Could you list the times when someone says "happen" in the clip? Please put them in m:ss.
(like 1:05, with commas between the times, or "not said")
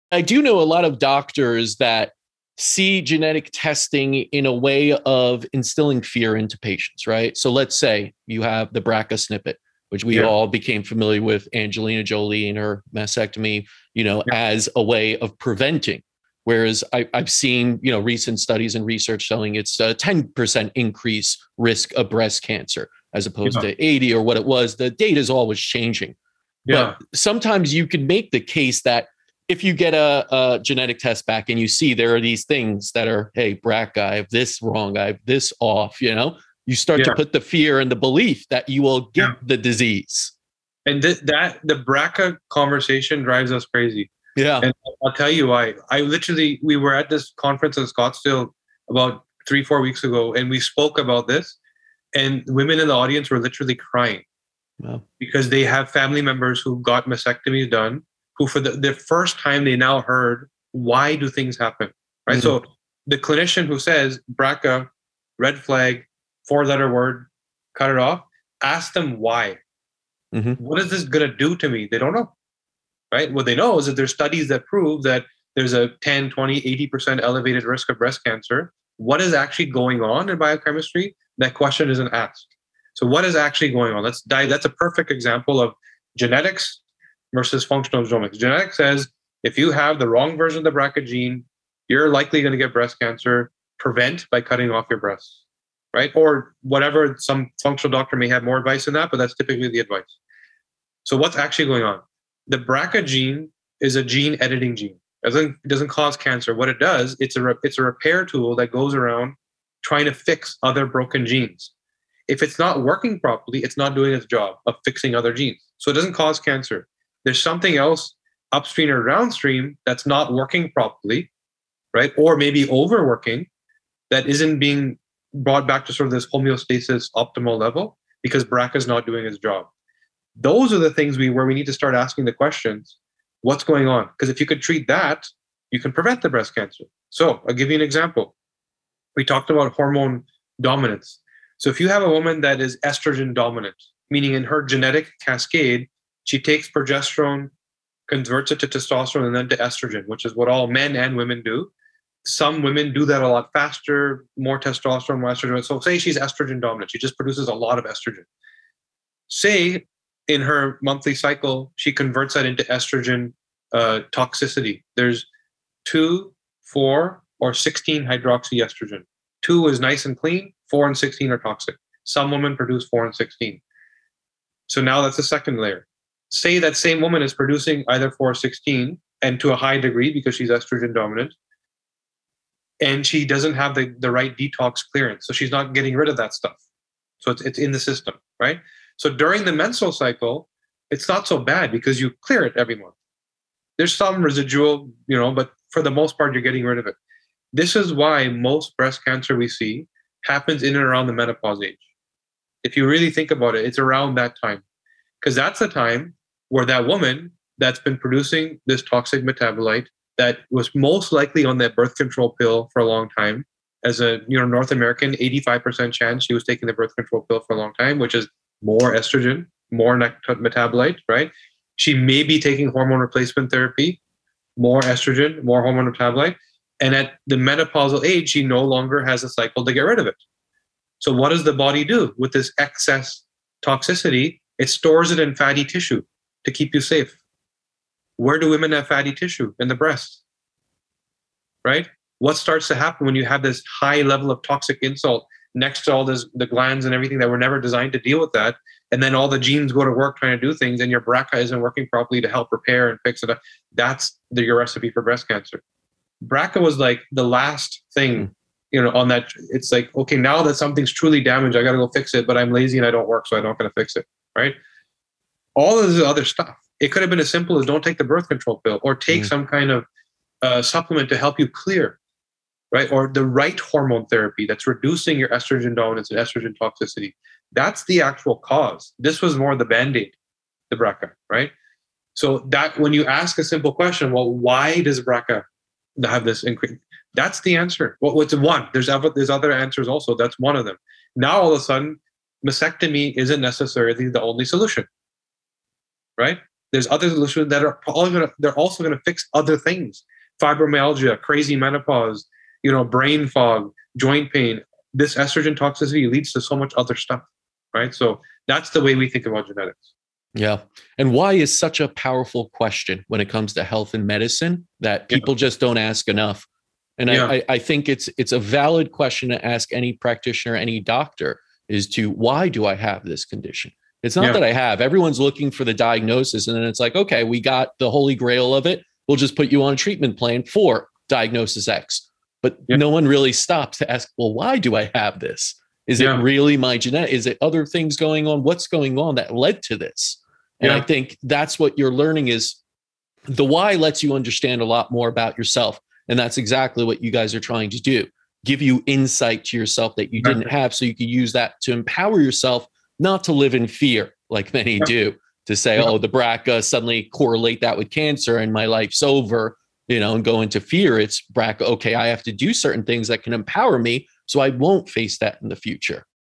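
1:01, 3:20, 4:02.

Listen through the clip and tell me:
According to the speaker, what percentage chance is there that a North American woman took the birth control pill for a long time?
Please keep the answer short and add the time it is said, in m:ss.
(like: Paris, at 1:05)
85%, at 3:35.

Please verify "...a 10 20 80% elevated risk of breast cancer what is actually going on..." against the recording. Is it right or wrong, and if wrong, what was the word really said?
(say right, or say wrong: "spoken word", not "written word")
right.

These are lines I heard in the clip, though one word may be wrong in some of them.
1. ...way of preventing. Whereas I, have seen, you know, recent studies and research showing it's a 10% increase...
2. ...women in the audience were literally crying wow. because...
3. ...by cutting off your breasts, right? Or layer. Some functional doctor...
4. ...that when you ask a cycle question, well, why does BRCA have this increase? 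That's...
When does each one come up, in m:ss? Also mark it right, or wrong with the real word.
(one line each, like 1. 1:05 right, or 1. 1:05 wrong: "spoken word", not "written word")
1. 0:14 right
2. 0:52 right
3. 1:34 wrong: "whatever", not "layer"
4. 4:42 wrong: "simple", not "cycle".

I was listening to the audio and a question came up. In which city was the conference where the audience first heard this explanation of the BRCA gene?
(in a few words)
Scottsdale.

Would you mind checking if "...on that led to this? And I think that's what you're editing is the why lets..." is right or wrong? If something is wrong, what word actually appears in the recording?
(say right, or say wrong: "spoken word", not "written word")
wrong: "learning", not "editing".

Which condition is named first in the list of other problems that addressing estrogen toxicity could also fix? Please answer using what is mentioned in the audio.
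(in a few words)
Fibromyalgia.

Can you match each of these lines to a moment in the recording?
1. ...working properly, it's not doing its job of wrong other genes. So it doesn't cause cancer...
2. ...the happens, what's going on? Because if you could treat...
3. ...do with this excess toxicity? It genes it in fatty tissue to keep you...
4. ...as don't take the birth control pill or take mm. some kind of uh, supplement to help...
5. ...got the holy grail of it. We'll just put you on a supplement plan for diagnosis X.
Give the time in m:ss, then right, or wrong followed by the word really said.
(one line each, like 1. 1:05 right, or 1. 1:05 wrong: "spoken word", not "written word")
1. 1:52 wrong: "fixing", not "wrong"
2. 2:12 wrong: "questions", not "happens"
3. 3:51 wrong: "stores", not "genes"
4. 4:27 right
5. 5:27 wrong: "treatment", not "supplement".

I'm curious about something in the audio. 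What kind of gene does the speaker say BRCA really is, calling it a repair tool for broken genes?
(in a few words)
Gene editing gene.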